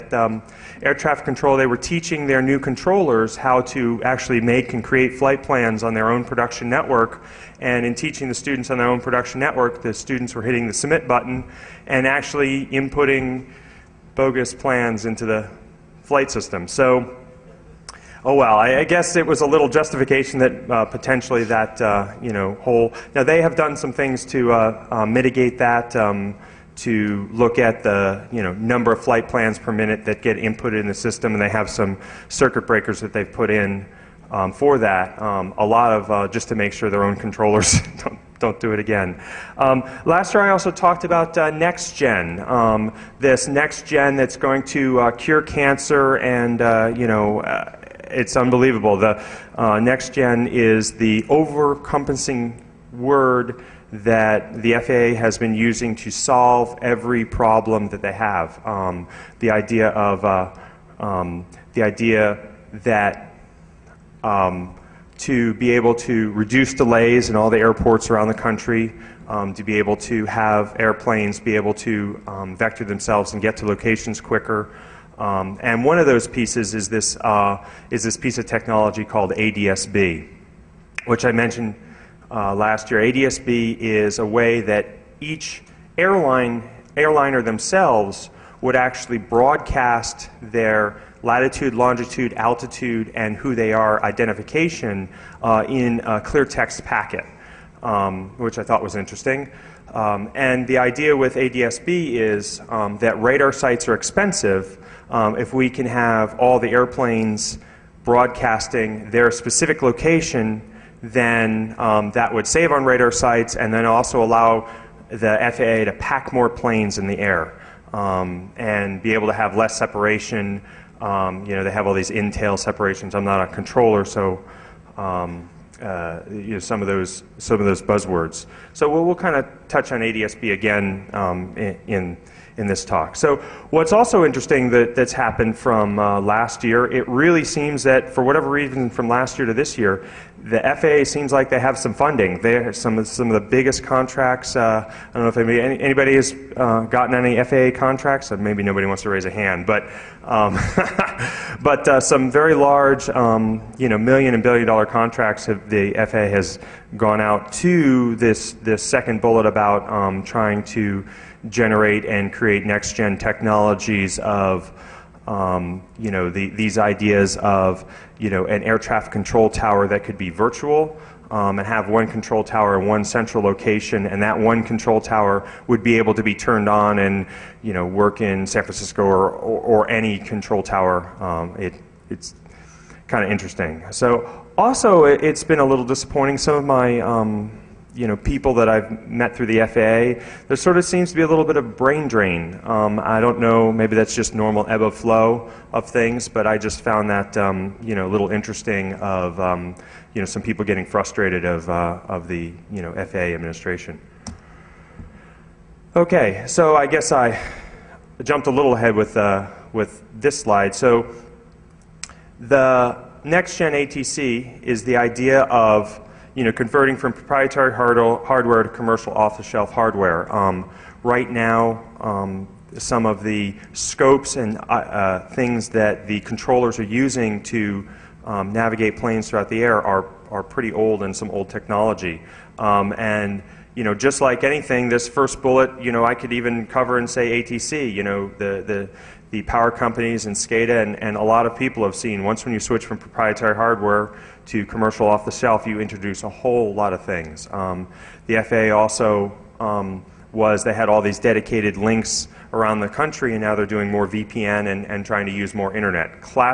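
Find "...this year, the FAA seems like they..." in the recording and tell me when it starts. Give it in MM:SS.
02:19.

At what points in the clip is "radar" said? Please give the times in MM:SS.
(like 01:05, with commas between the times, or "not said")
01:43, 01:52.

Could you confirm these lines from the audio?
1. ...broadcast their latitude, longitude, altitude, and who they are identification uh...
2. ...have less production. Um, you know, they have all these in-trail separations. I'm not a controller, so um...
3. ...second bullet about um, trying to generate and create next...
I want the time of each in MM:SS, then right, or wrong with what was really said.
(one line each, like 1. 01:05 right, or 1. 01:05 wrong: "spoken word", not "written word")
1. 01:29 right
2. 01:59 wrong: "separation", not "production"
3. 02:38 right.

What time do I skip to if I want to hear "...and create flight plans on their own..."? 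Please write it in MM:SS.
00:04.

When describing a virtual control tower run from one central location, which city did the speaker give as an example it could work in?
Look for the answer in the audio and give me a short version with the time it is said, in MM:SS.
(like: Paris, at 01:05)
San Francisco, at 02:58.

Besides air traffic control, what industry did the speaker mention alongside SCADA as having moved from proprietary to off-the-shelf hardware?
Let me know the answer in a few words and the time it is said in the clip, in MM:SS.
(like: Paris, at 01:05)
power companies, at 03:59.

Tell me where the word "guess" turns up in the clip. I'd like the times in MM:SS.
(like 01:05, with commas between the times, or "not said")
00:18, 03:26.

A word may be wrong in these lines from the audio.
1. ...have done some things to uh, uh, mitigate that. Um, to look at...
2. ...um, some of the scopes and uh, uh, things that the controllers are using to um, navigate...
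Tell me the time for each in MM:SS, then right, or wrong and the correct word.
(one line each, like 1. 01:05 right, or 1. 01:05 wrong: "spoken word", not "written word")
1. 00:23 right
2. 03:41 right.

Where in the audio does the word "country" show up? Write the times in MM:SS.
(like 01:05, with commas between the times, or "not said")
01:08, 04:12.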